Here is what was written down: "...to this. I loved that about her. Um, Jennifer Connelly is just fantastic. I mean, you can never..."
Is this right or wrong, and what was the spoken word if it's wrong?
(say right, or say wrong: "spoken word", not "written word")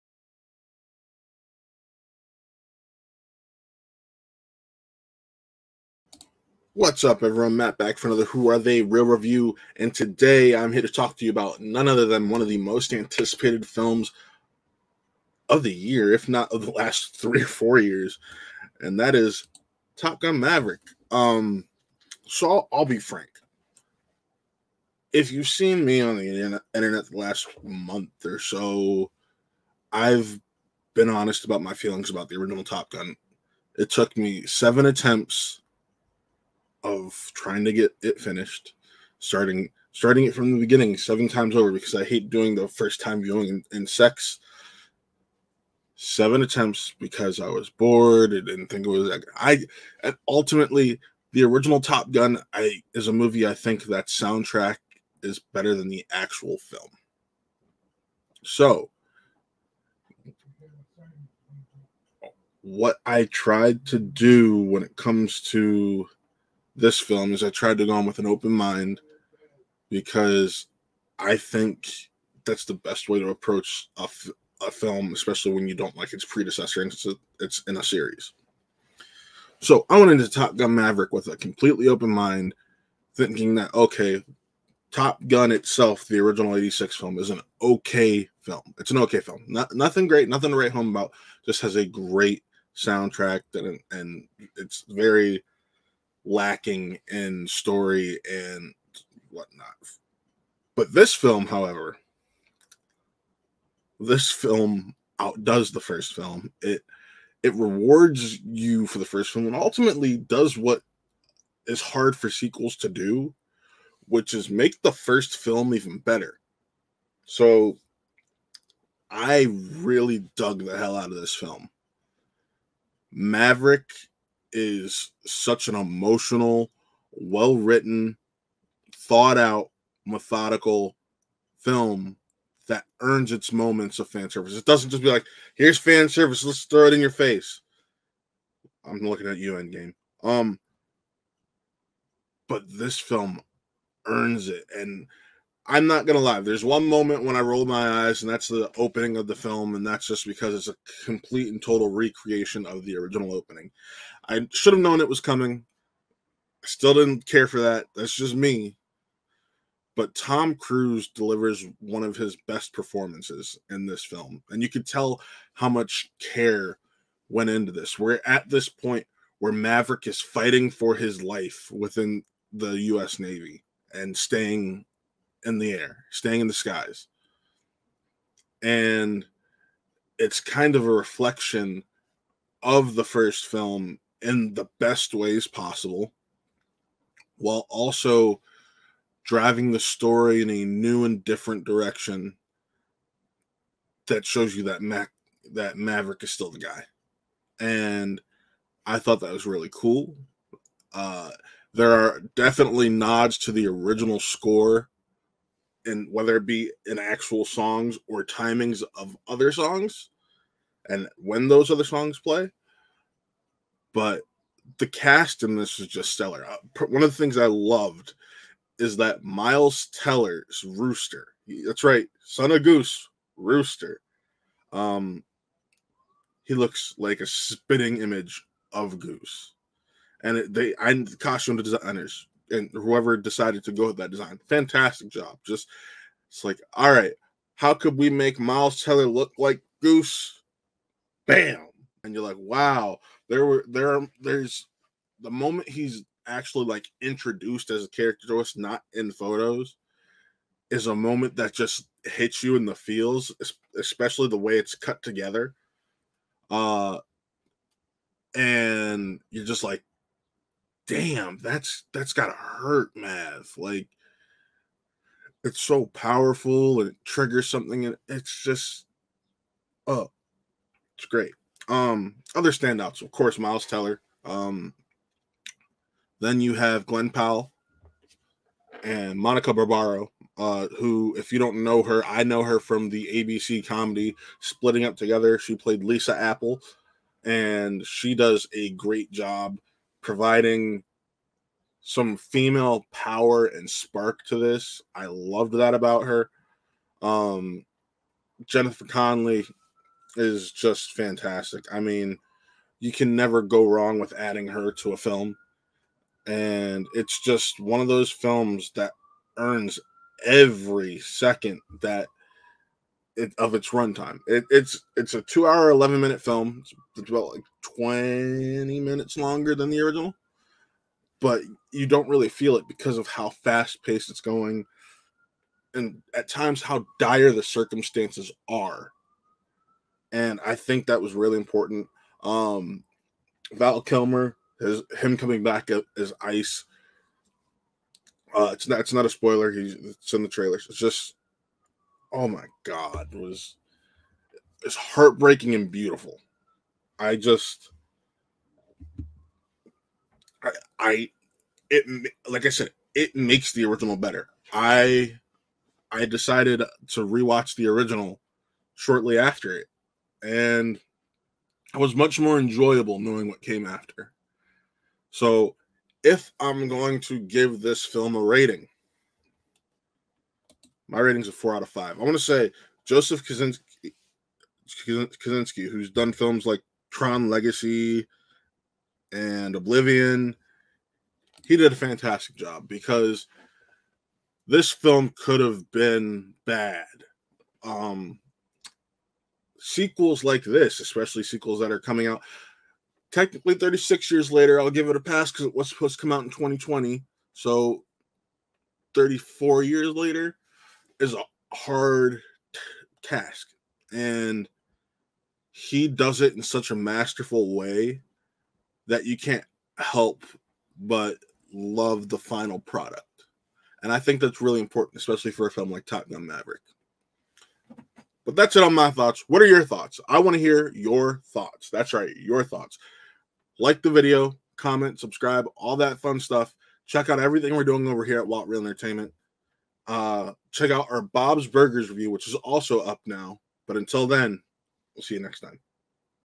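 right.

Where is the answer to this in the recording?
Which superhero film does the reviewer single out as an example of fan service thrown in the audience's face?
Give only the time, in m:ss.
2:19.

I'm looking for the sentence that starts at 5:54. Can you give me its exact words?
I I decided to rewatch the original shortly after it and it was much more enjoyable knowing what came after.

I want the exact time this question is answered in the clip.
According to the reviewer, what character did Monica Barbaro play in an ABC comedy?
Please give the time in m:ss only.
4:45.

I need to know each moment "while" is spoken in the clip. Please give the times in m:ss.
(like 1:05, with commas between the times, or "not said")
3:07.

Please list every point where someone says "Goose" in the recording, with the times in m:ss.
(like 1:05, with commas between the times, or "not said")
3:42, 3:48, 3:59.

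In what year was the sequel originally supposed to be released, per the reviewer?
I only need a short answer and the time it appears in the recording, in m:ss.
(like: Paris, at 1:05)
2020, at 6:36.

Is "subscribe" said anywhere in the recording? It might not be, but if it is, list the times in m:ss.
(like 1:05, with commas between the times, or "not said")
7:04.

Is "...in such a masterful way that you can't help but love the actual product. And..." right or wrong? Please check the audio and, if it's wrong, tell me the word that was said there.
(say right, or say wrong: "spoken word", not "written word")
wrong: "final", not "actual".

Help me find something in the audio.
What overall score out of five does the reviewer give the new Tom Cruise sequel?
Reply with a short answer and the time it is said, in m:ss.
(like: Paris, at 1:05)
4 out of 5, at 6:11.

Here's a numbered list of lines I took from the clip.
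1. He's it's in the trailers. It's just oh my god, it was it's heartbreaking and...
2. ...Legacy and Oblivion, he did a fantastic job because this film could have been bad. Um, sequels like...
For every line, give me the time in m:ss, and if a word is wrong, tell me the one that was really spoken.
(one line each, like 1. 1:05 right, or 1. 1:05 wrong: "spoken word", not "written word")
1. 5:39 right
2. 6:17 right.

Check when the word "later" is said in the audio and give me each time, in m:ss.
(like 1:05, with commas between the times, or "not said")
6:34, 6:39.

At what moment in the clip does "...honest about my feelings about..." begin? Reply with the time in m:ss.
0:31.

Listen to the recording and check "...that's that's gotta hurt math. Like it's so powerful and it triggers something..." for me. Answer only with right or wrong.
right.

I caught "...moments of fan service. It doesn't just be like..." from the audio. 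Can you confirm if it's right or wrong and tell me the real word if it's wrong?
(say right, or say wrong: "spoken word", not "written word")
right.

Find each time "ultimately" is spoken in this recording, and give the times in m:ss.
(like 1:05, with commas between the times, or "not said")
0:50, 1:49.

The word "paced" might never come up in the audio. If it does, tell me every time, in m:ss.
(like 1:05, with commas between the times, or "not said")
5:23.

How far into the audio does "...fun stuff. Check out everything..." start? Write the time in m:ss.
7:05.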